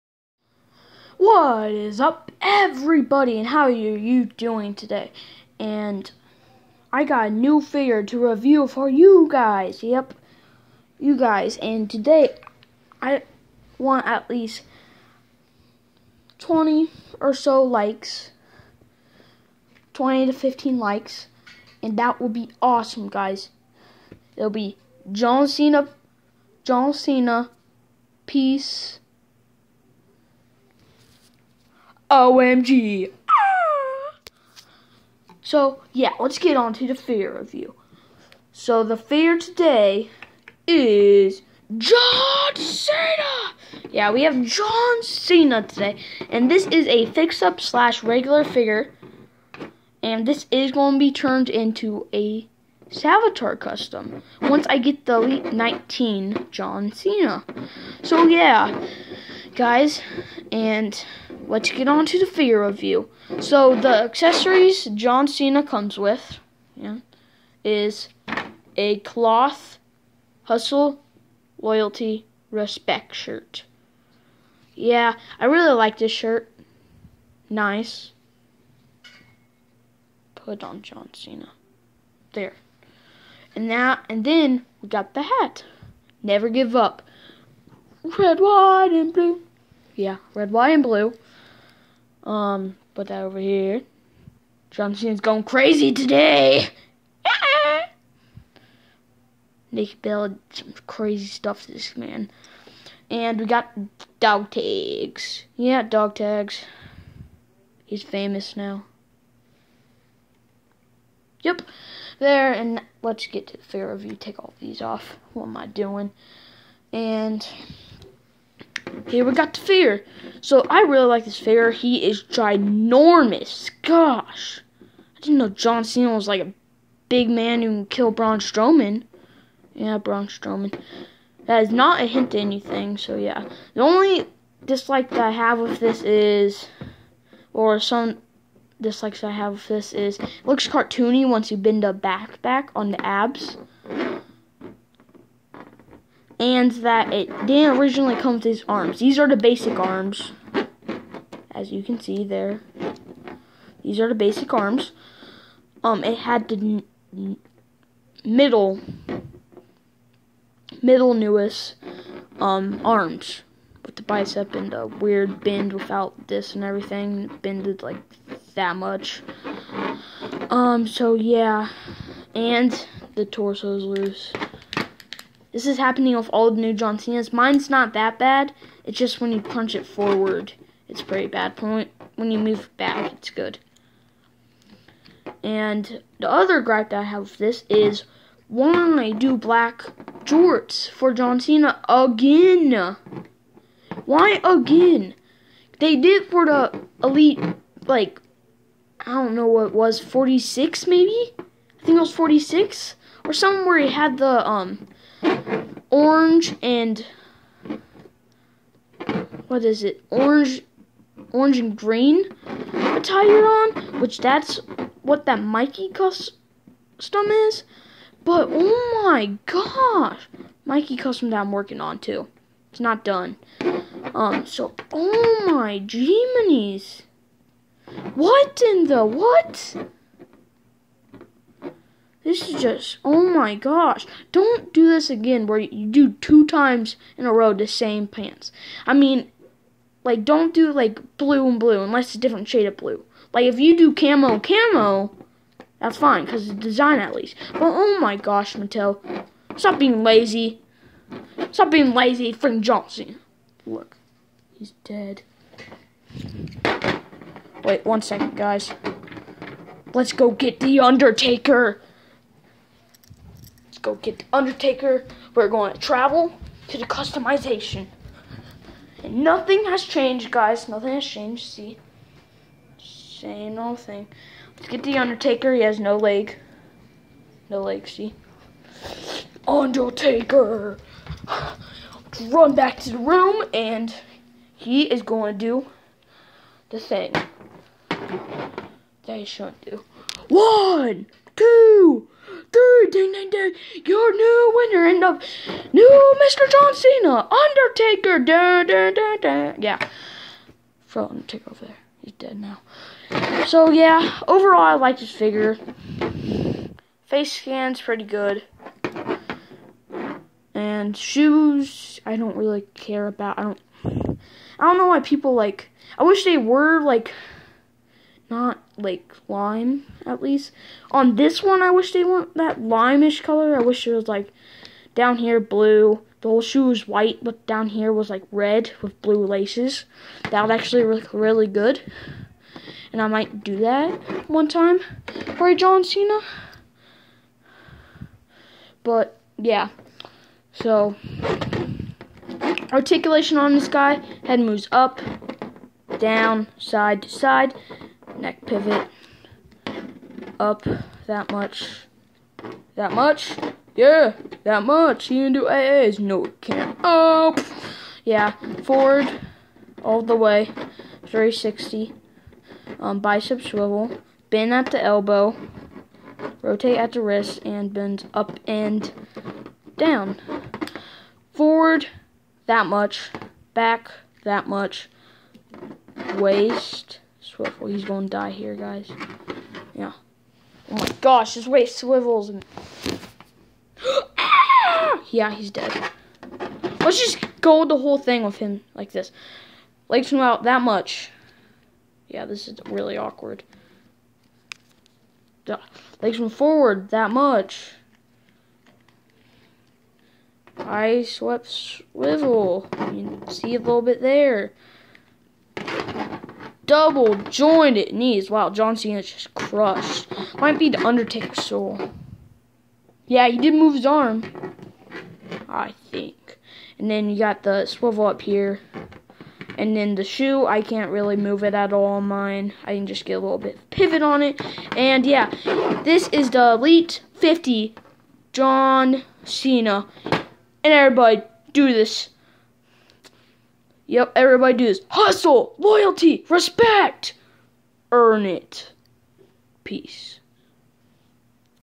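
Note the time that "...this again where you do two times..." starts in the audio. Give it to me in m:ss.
3:54.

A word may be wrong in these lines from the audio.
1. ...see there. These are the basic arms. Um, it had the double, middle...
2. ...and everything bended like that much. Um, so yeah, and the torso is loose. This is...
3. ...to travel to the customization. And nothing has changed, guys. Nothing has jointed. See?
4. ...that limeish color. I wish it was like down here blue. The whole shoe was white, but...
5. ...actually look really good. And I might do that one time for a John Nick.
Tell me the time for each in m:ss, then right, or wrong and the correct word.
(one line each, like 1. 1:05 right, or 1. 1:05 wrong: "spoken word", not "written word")
1. 2:31 wrong: "middle", not "double"
2. 2:46 right
3. 4:25 wrong: "changed", not "jointed"
4. 5:22 right
5. 5:30 wrong: "Cena", not "Nick".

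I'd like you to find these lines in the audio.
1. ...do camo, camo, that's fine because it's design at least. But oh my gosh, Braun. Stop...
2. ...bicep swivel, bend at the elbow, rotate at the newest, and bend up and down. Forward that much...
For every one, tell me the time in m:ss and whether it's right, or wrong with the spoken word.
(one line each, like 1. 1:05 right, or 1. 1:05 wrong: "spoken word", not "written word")
1. 4:03 wrong: "Mattel", not "Braun"
2. 6:02 wrong: "wrist", not "newest".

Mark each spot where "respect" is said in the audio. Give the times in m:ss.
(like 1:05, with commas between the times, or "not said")
1:12, 7:16.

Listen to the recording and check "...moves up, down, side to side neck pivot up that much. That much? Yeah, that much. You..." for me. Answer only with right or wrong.
right.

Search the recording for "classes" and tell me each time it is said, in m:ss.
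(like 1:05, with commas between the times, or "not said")
not said.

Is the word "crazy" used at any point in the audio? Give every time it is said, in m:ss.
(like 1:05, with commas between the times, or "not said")
1:35, 1:40.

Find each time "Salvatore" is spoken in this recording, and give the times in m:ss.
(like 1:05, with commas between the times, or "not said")
0:52.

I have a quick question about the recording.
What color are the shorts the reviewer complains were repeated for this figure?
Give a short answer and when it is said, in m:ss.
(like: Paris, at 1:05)
Black, at 3:09.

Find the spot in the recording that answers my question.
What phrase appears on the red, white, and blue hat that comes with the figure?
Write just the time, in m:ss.
1:26.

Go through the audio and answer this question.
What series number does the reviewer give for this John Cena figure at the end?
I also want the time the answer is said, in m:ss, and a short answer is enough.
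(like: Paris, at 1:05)
Elite 50, at 7:06.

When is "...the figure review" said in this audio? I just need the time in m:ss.
1:02.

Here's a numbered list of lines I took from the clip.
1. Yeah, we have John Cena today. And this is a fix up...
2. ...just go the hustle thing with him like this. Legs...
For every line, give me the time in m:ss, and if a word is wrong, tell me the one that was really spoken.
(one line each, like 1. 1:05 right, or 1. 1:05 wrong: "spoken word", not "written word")
1. 0:43 right
2. 6:26 wrong: "whole", not "hustle".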